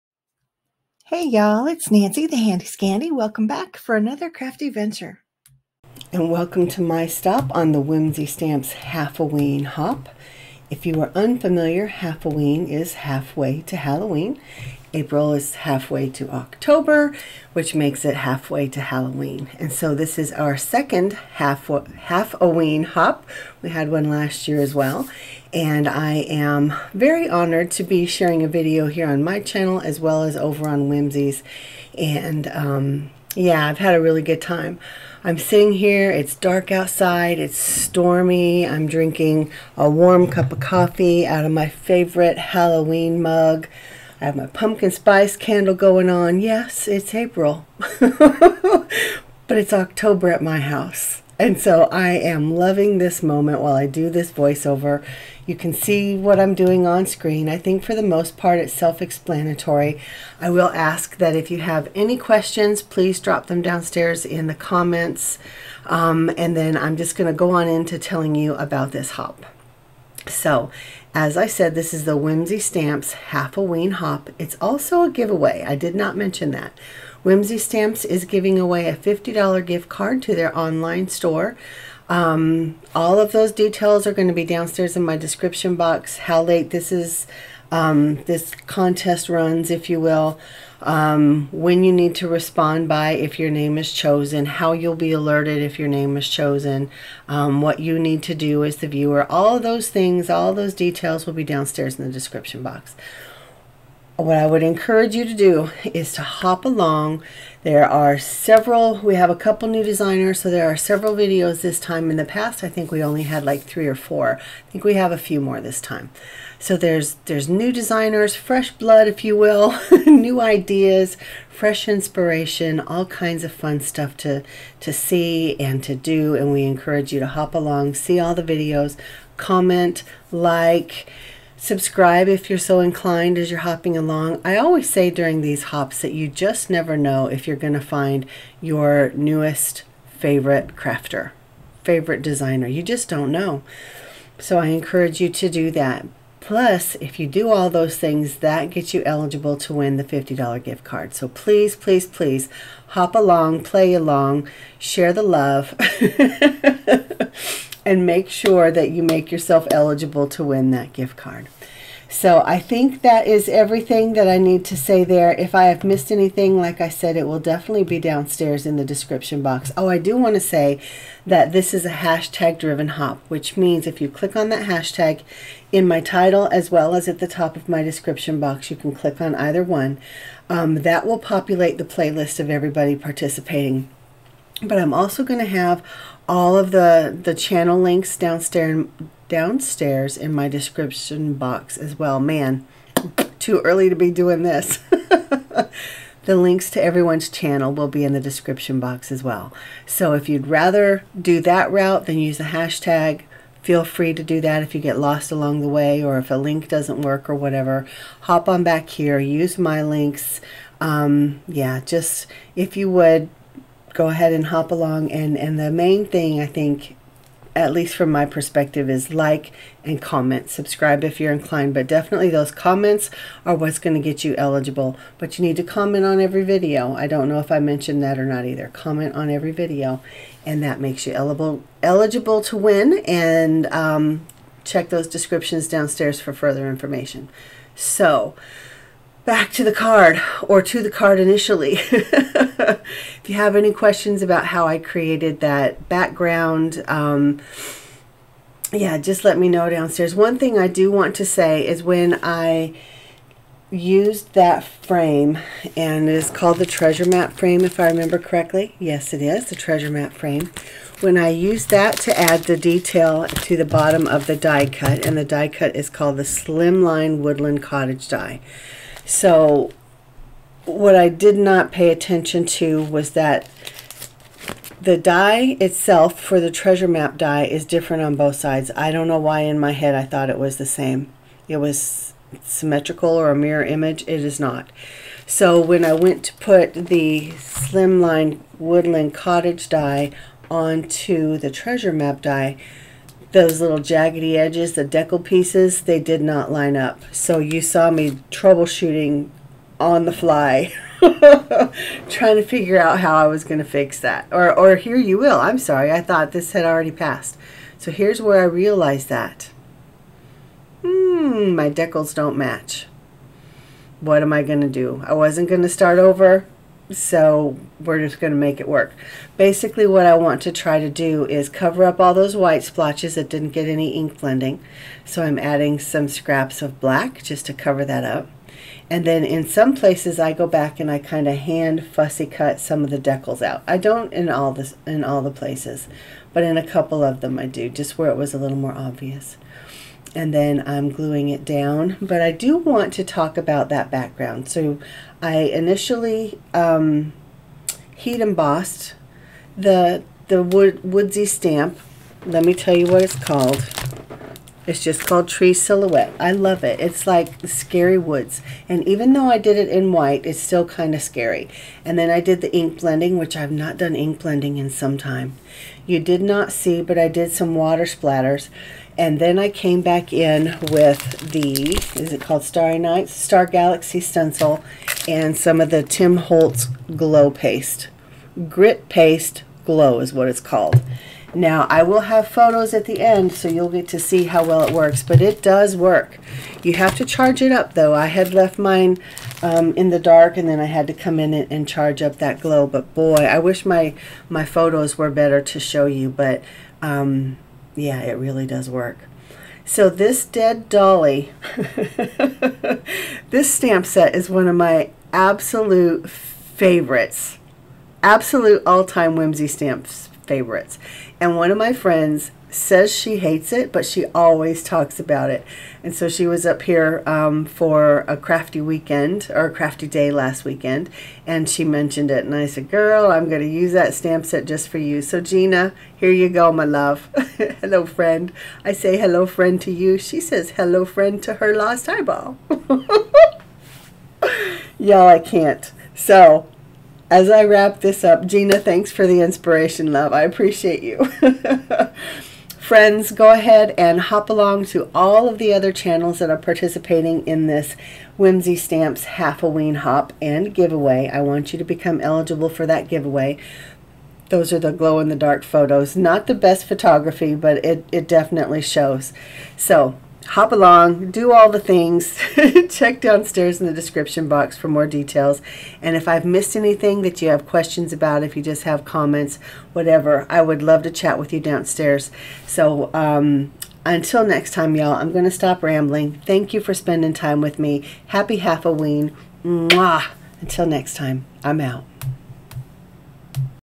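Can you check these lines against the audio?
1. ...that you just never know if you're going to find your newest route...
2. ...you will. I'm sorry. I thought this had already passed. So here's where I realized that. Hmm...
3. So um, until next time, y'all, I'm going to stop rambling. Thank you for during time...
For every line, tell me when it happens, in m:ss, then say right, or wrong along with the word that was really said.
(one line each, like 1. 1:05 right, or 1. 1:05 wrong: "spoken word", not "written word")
1. 2:16 wrong: "favorite", not "route"
2. 5:04 right
3. 7:52 wrong: "spending", not "during".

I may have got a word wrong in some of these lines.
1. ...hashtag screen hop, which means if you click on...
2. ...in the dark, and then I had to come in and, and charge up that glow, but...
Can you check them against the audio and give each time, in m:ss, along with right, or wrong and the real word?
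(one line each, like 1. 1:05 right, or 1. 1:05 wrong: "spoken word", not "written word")
1. 2:51 wrong: "driven", not "screen"
2. 6:29 right.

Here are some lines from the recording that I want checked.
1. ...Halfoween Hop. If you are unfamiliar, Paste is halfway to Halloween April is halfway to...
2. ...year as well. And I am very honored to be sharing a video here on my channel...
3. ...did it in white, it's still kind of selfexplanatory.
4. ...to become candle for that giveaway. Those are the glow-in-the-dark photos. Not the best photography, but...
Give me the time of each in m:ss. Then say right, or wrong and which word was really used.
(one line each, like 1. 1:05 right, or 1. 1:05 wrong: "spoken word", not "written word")
1. 0:08 wrong: "Halfoween", not "Paste"
2. 0:24 right
3. 5:59 wrong: "scary", not "selfexplanatory"
4. 7:31 wrong: "eligible", not "candle".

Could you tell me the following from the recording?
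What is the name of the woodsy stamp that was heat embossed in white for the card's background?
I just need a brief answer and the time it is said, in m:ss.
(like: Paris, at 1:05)
Tree Silhouette, at 5:55.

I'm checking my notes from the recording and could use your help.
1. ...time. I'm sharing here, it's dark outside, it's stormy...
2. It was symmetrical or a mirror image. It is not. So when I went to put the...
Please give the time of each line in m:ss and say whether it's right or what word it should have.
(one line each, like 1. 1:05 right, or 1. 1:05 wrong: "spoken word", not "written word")
1. 0:34 wrong: "sitting", not "sharing"
2. 4:41 right.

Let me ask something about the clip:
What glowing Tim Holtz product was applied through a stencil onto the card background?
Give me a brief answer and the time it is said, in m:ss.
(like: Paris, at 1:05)
Grit Paste Glow, at 6:18.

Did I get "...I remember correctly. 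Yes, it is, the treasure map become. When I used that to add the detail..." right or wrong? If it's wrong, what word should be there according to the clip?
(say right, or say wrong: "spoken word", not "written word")
wrong: "frame", not "become".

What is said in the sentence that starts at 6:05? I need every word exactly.
You did not see, but I did some water splatters.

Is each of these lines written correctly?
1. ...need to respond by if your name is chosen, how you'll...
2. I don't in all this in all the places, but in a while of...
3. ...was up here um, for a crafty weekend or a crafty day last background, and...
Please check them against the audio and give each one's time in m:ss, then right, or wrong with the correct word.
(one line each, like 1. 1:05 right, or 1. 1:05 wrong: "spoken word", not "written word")
1. 1:31 right
2. 5:33 wrong: "couple", not "while"
3. 6:56 wrong: "weekend", not "background".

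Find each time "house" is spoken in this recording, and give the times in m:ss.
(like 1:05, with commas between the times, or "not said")
0:50.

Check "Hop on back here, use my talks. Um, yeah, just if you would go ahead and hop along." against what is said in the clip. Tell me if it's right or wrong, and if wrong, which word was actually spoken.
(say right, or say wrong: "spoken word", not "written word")
wrong: "links", not "talks".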